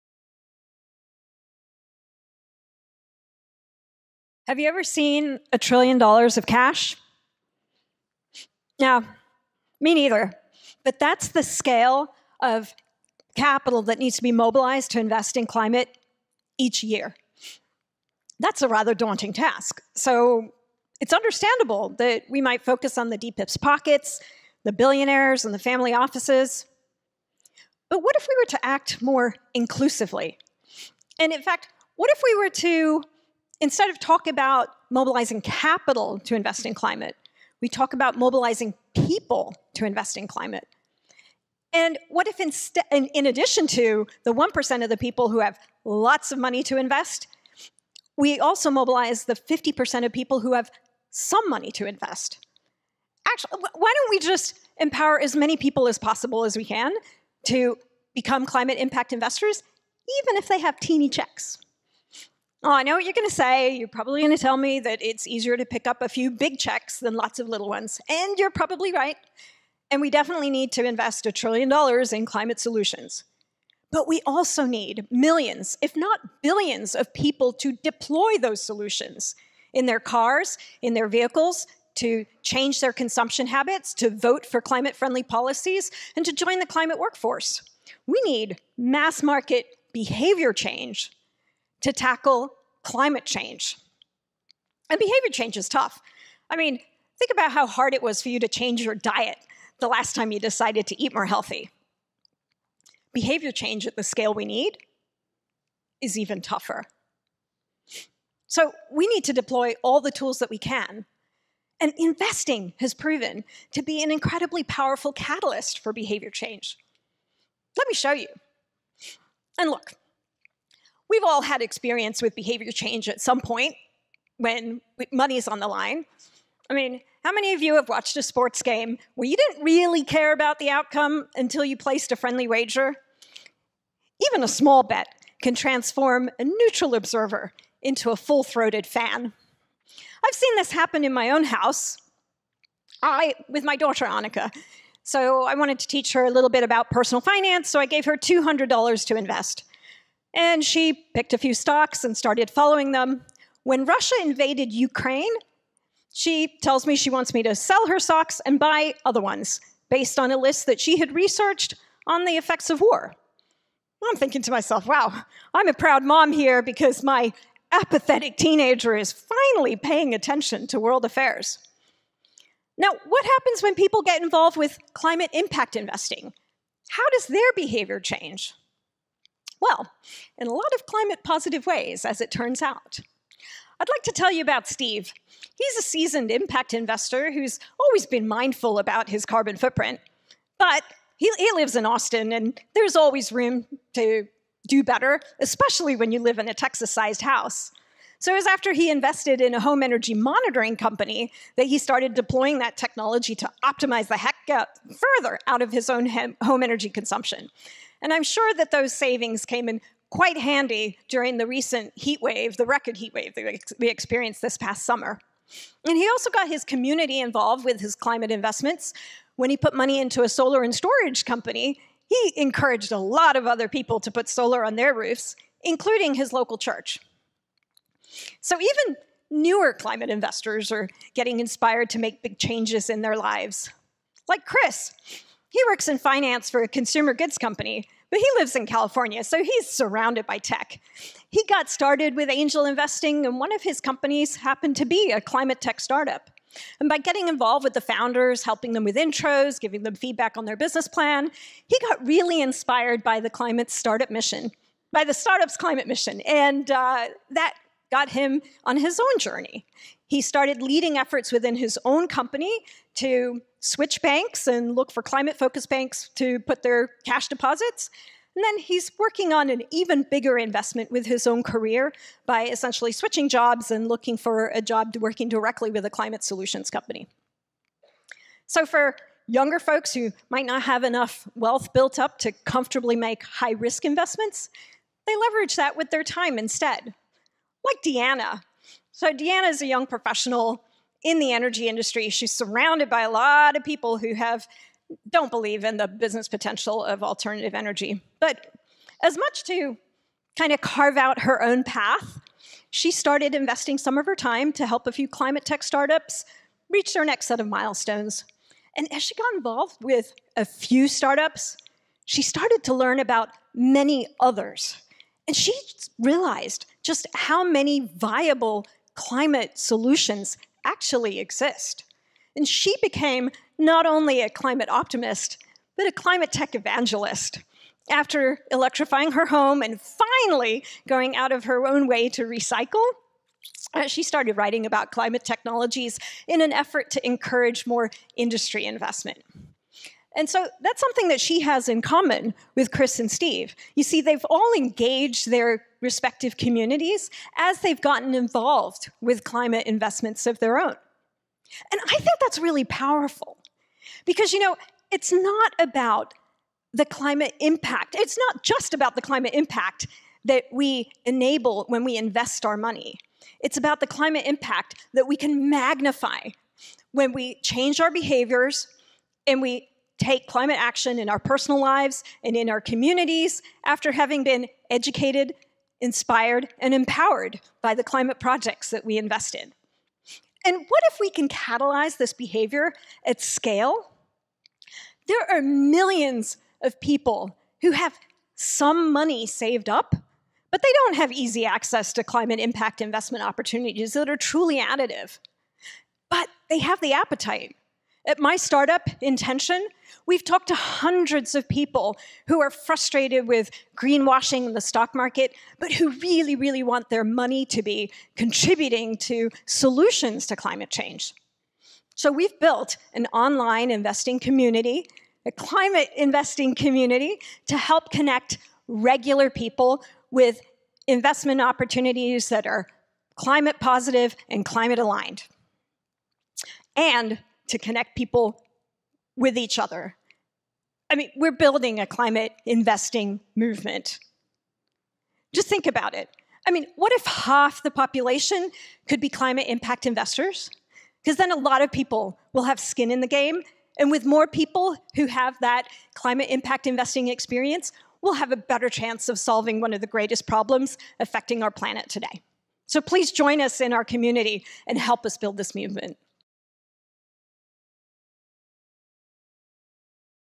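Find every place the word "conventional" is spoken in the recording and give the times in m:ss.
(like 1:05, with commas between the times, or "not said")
not said.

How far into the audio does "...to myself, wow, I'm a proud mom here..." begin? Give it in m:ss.
2:44.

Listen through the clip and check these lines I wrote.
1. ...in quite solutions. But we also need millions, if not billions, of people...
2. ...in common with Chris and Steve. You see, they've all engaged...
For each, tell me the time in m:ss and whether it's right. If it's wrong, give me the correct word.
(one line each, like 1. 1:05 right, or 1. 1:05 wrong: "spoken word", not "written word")
1. 1:12 wrong: "climate", not "quite"
2. 5:41 right.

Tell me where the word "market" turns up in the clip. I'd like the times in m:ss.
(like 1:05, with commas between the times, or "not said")
1:29, 6:44.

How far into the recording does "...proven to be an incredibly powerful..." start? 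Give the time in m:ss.
1:52.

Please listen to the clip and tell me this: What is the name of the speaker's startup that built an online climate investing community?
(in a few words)
Intention.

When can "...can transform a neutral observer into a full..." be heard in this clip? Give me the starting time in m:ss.
2:15.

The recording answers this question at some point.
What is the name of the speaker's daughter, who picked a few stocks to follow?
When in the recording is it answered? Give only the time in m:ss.
2:24.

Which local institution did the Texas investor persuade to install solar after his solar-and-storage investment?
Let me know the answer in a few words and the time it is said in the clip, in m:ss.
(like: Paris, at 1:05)
his local church, at 3:46.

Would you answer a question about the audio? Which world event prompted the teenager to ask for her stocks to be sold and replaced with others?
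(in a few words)
Russia invaded Ukraine.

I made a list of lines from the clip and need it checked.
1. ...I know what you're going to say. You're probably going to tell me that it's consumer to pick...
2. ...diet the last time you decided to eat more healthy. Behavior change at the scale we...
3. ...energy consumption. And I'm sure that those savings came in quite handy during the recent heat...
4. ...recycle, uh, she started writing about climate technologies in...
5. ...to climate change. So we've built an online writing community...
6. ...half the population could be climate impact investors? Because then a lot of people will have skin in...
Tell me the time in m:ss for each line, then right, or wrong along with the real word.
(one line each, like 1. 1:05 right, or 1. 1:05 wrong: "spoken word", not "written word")
1. 1:02 wrong: "easier", not "consumer"
2. 1:38 right
3. 3:26 right
4. 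5:32 right
5. 6:50 wrong: "investing", not "writing"
6. 7:17 right.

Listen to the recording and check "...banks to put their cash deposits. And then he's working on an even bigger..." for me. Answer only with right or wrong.
right.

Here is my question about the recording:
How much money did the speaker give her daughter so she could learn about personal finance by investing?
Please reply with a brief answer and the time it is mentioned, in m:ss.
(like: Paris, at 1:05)
$200, at 2:28.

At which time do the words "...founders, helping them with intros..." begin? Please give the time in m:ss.
4:07.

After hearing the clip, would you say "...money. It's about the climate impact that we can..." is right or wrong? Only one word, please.
right.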